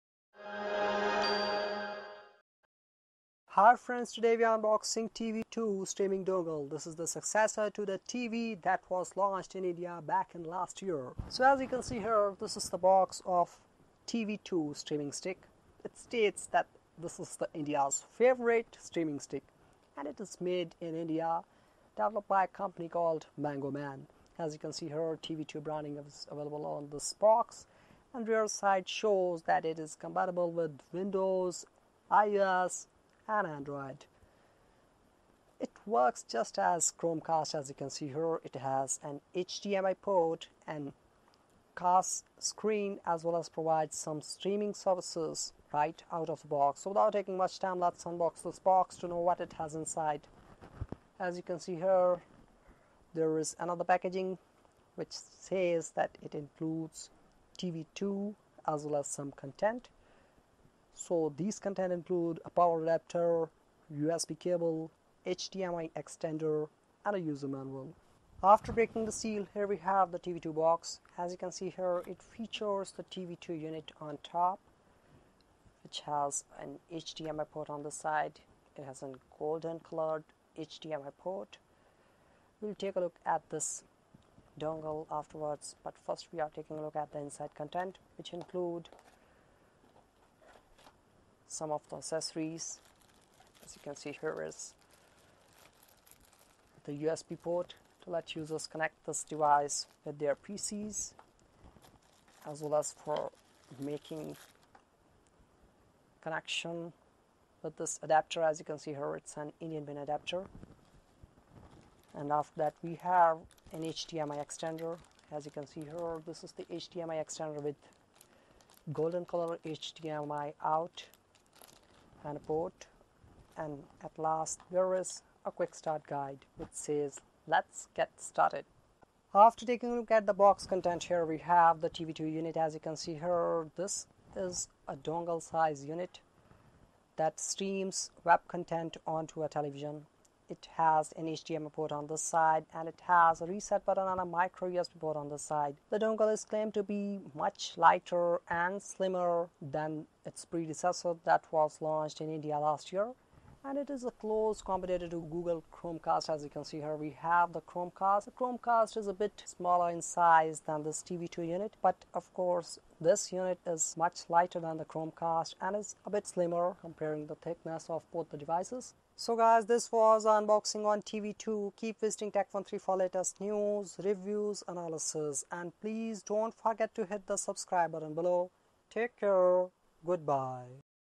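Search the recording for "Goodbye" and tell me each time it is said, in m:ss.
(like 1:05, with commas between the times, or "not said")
3:00.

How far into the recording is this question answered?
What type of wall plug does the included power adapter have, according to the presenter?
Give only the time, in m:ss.
1:49.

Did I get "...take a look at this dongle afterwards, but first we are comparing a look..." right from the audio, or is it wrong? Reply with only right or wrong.
wrong.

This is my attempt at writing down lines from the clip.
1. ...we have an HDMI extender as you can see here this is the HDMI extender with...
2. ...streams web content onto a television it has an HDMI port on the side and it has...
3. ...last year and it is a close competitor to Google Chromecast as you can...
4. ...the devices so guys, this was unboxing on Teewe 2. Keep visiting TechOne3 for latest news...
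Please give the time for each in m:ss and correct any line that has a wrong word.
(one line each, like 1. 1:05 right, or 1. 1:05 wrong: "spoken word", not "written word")
1. 1:52 right
2. 2:17 right
3. 2:32 right
4. 2:48 right.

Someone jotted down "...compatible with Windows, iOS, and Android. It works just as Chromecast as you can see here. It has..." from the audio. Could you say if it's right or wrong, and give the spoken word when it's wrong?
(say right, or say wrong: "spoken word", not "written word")
right.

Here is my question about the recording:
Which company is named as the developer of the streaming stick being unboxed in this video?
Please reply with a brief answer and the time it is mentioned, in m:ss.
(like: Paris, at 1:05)
Mango Man, at 0:23.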